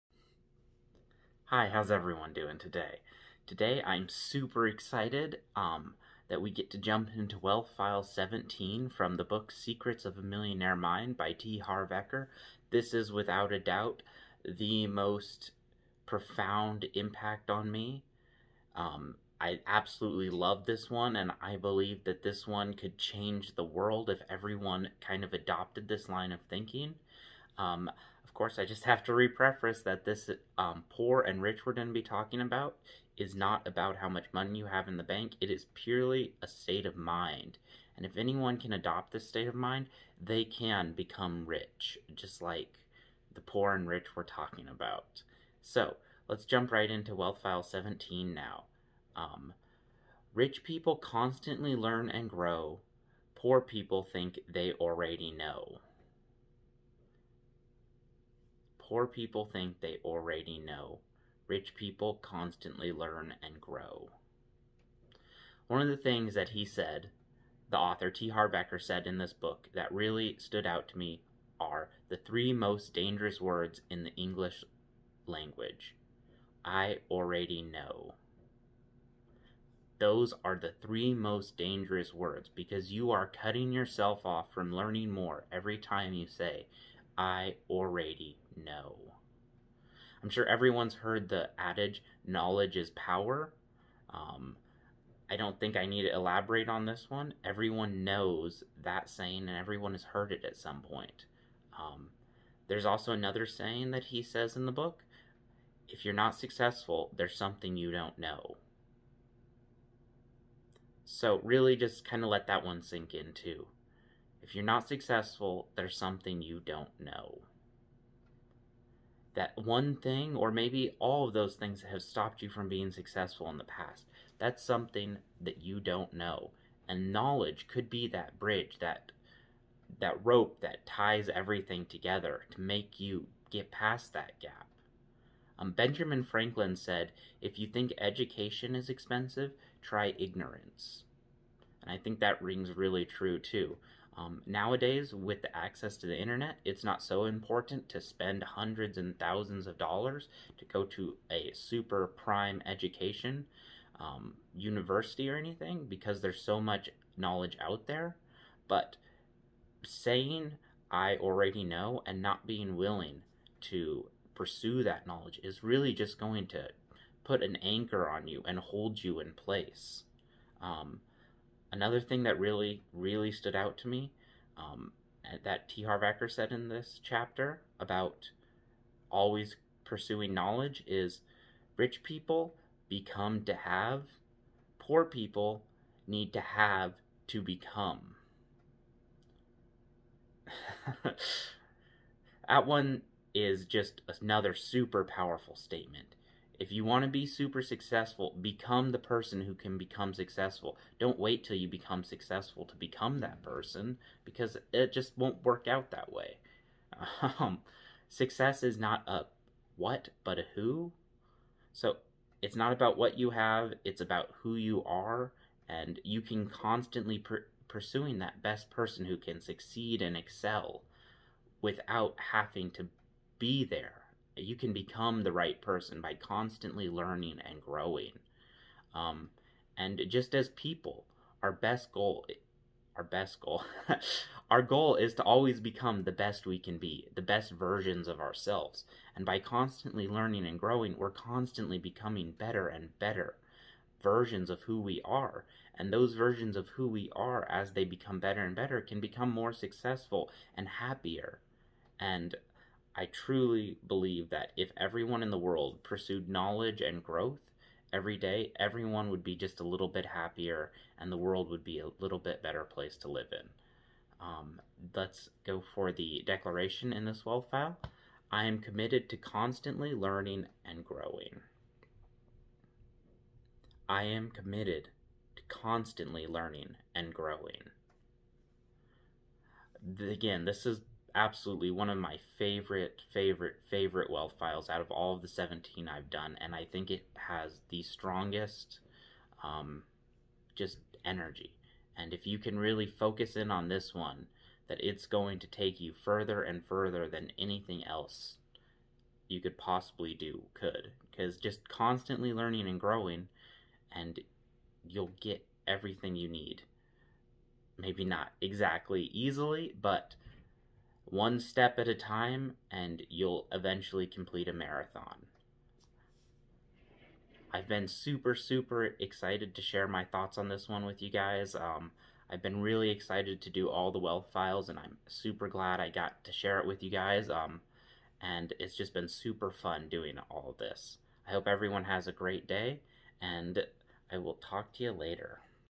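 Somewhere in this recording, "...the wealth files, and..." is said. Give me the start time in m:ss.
5:23.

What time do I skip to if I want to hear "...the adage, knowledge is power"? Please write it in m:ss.
1:31.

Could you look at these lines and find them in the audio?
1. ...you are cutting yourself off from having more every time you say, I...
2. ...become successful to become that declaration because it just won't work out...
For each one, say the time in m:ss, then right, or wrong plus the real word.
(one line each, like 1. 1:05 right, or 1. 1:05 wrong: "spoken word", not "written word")
1. 1:22 wrong: "learning", not "having"
2. 3:21 wrong: "person", not "declaration".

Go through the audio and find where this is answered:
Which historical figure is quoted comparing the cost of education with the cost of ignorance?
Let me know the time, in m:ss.
2:15.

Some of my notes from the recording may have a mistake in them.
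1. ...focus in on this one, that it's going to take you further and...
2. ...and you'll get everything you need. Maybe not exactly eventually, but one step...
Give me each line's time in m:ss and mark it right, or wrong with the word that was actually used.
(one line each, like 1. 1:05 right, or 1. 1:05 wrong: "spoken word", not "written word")
1. 4:52 right
2. 5:03 wrong: "easily", not "eventually".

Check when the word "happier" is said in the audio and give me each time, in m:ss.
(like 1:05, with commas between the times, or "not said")
4:10, 4:20.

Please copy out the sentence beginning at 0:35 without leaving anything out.
It is purely a state of mind.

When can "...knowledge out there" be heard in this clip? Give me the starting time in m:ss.
2:37.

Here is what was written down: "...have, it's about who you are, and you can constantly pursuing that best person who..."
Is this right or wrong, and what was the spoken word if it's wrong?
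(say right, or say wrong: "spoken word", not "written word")
right.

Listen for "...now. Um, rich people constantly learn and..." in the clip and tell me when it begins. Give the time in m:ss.
0:48.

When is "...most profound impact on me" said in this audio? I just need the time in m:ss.
0:14.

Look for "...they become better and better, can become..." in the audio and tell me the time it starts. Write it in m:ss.
4:07.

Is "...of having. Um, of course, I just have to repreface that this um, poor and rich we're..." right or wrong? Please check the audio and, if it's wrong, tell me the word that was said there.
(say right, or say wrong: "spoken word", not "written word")
wrong: "thinking", not "having".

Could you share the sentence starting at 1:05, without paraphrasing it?
One of the things that he said, the author T.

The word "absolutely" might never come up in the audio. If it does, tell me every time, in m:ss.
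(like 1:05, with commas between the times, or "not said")
0:19, 4:41.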